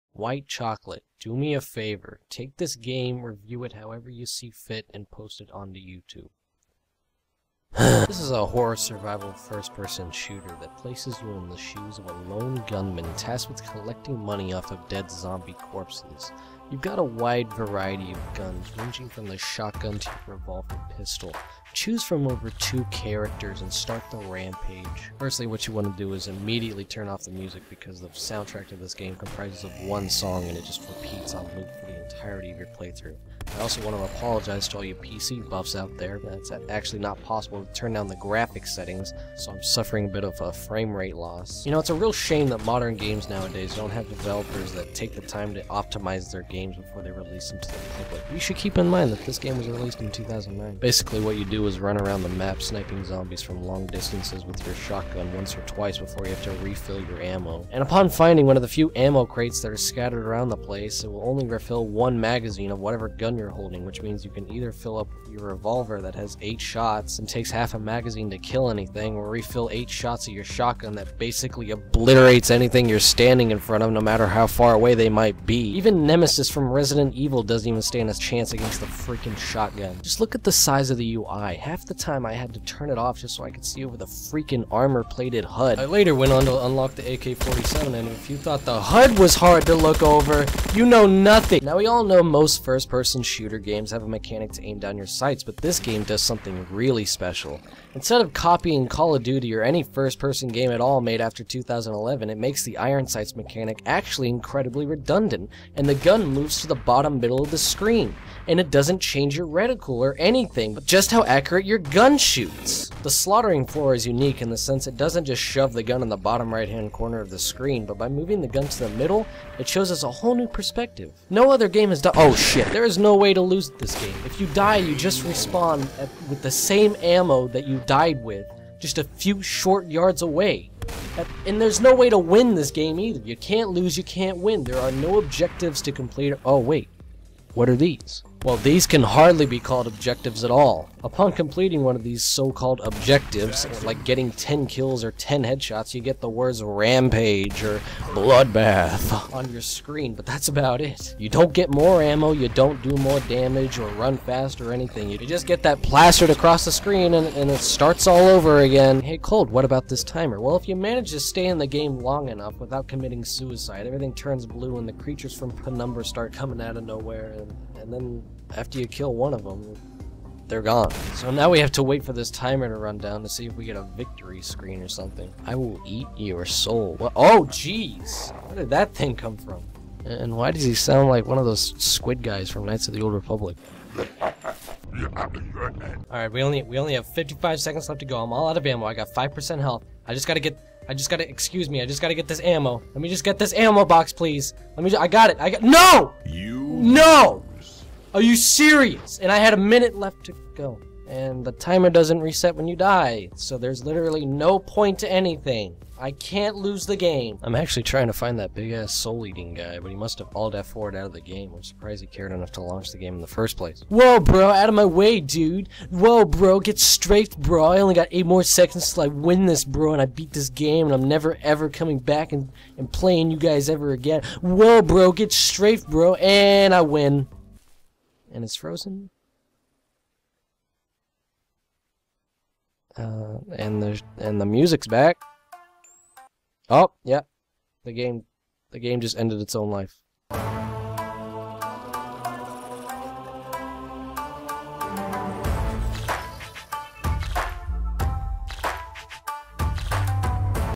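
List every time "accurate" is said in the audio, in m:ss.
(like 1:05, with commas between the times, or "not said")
1:51.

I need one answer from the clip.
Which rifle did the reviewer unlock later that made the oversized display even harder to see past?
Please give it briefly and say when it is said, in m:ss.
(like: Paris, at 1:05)
AK-47, at 1:27.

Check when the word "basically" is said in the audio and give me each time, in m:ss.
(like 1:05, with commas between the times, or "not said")
0:50, 1:11.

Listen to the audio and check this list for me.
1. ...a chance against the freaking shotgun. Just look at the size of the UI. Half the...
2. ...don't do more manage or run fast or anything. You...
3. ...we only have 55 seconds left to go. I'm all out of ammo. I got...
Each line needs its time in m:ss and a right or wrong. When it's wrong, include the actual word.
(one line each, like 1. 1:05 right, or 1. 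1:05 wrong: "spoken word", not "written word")
1. 1:18 right
2. 2:32 wrong: "damage", not "manage"
3. 3:06 right.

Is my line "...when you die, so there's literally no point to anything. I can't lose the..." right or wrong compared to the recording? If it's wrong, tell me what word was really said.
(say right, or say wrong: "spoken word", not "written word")
right.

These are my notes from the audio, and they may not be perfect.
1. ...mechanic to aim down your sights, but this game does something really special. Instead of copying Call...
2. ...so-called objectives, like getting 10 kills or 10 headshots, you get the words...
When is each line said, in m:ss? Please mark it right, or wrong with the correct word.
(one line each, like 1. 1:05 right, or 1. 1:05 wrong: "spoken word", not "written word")
1. 1:34 right
2. 2:22 right.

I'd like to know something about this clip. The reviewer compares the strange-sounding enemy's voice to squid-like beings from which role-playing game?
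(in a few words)
Knights of the Old Republic.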